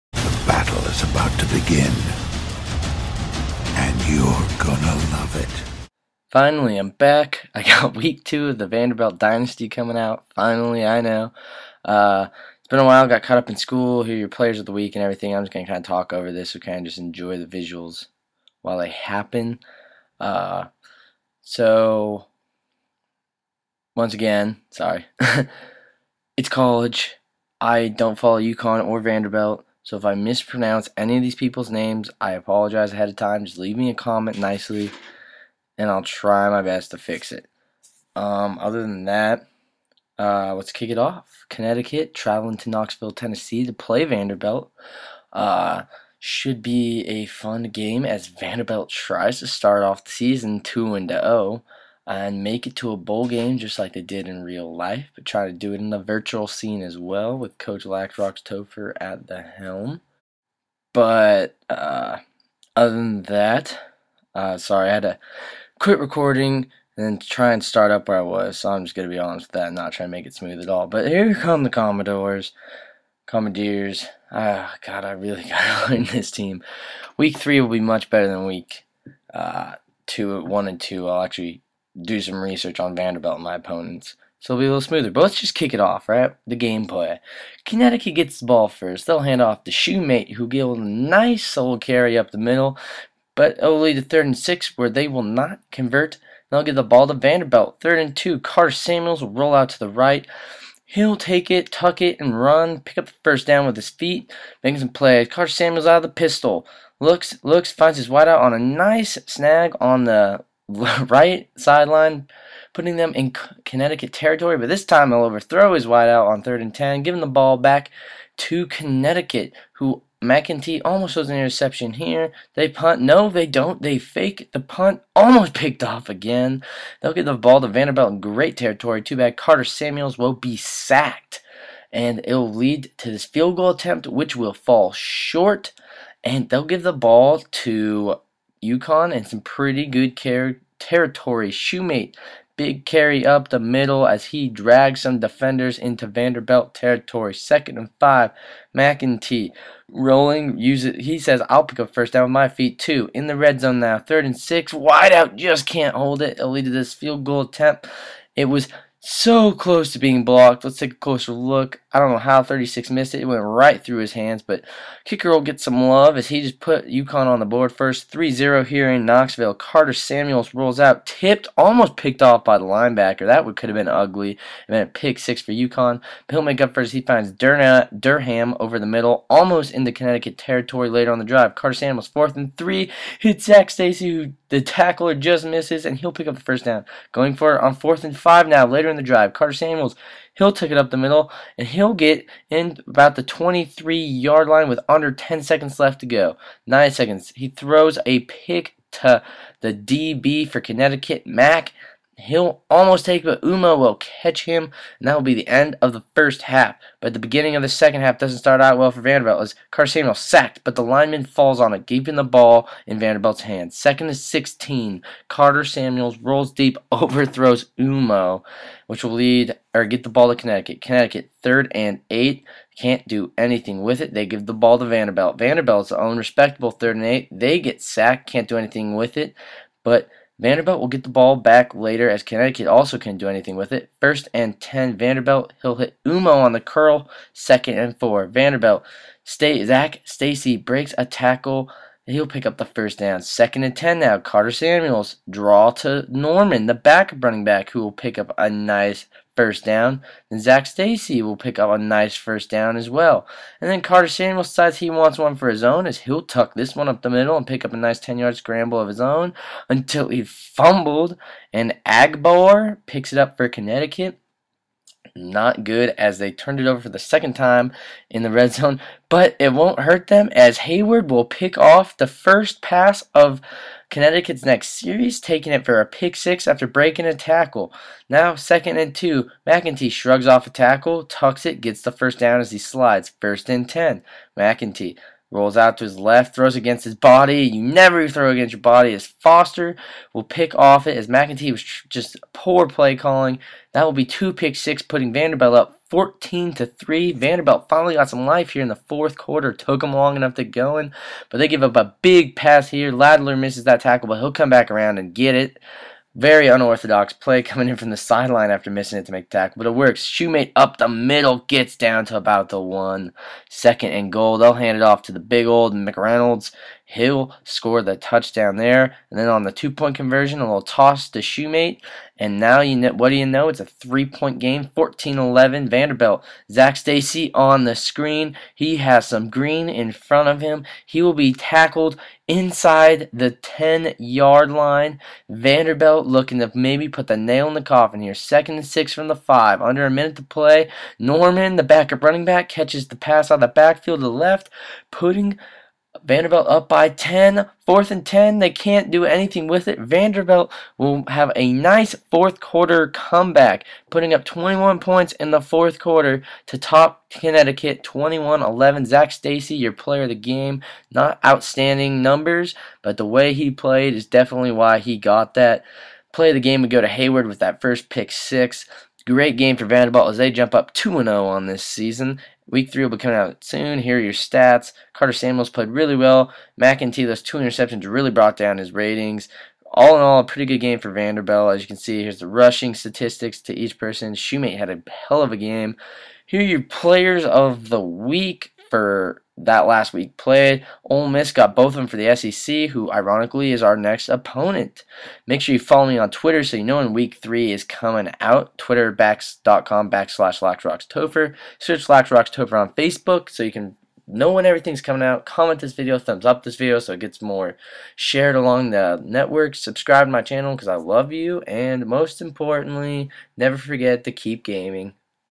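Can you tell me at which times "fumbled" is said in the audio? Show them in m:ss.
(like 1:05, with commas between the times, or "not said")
4:20.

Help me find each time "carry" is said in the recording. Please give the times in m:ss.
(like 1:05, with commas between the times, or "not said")
1:31, 2:22.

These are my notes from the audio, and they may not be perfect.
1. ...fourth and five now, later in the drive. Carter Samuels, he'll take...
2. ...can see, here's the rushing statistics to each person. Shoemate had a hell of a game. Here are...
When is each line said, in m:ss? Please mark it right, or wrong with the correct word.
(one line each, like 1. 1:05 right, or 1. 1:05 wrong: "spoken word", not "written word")
1. 3:07 right
2. 6:21 right.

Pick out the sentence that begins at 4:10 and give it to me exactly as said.
Then Zach Stacy will pick up a nice first down as well.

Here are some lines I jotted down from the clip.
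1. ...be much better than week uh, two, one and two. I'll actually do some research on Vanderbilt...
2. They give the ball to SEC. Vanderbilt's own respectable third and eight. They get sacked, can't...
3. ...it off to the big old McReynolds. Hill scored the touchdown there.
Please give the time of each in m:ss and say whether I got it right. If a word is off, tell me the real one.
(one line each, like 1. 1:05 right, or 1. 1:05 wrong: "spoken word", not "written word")
1. 1:17 right
2. 3:44 wrong: "Vanderbilt", not "SEC"
3. 5:14 right.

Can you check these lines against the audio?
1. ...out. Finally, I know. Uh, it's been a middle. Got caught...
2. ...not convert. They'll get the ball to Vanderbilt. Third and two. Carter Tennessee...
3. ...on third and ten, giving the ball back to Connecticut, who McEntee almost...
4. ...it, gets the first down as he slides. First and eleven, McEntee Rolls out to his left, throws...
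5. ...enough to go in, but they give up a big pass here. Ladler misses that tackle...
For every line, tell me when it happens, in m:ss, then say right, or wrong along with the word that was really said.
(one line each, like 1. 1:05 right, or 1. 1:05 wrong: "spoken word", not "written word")
1. 0:09 wrong: "while", not "middle"
2. 1:35 wrong: "Samuels", not "Tennessee"
3. 1:56 right
4. 4:41 wrong: "ten", not "eleven"
5. 5:00 right.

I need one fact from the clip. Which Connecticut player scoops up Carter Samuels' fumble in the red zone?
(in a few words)
Agbar.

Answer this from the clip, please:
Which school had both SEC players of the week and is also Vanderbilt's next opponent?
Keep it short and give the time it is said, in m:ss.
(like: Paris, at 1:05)
Ole Miss, at 6:30.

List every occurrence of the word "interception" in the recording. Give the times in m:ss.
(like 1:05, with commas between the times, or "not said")
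2:01, 6:17.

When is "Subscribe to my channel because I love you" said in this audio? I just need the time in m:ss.
6:49.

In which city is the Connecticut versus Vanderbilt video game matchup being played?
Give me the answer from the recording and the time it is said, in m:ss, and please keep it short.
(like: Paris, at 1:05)
Knoxville, Tennessee, at 0:42.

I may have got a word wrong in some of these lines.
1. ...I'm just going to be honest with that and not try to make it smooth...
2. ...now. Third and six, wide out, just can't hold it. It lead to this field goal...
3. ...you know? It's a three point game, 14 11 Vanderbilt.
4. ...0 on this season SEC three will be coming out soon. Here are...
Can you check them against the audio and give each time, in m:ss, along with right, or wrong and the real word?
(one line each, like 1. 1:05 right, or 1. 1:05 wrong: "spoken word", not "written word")
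1. 1:08 right
2. 2:33 right
3. 5:23 right
4. 6:11 wrong: "Week", not "SEC".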